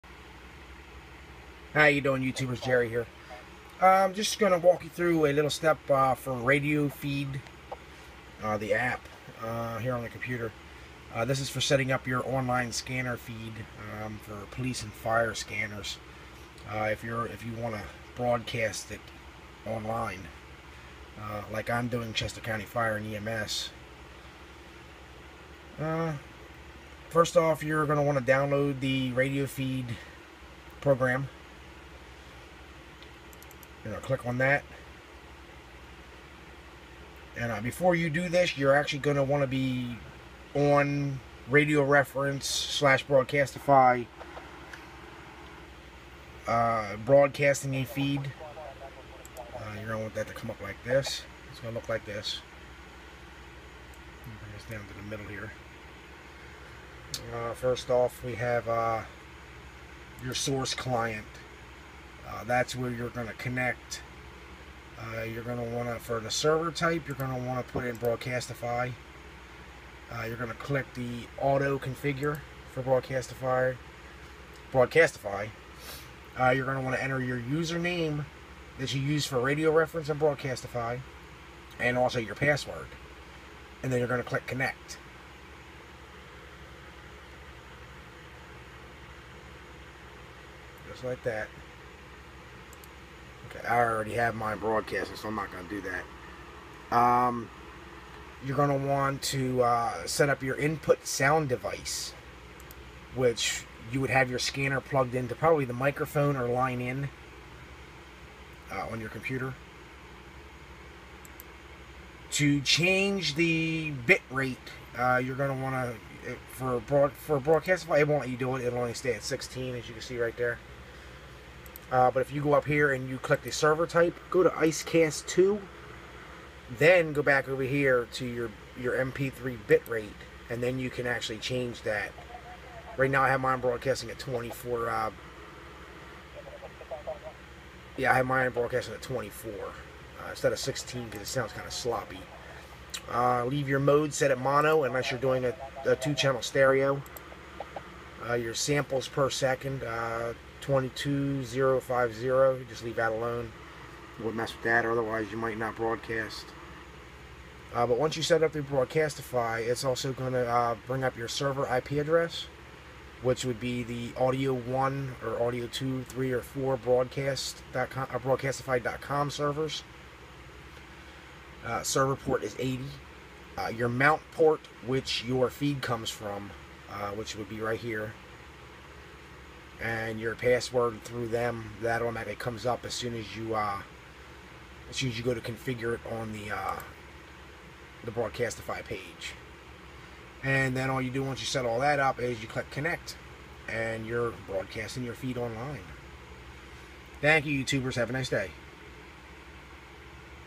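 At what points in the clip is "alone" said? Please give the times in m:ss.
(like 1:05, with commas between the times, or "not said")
2:33.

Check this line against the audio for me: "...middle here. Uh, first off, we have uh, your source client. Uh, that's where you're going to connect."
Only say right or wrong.
right.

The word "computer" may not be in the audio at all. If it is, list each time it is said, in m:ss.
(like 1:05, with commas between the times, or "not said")
0:10, 1:49.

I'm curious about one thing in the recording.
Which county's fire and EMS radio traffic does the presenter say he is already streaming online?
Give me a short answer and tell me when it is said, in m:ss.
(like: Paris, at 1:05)
Chester County, at 0:22.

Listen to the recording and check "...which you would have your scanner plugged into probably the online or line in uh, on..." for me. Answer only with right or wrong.
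wrong.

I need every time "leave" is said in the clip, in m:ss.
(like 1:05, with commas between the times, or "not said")
2:23, 2:32.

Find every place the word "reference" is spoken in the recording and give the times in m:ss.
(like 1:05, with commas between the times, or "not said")
0:41, 1:19.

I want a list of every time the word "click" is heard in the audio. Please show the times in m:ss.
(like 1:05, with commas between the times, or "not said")
0:34, 1:10, 1:24, 2:03, 3:12.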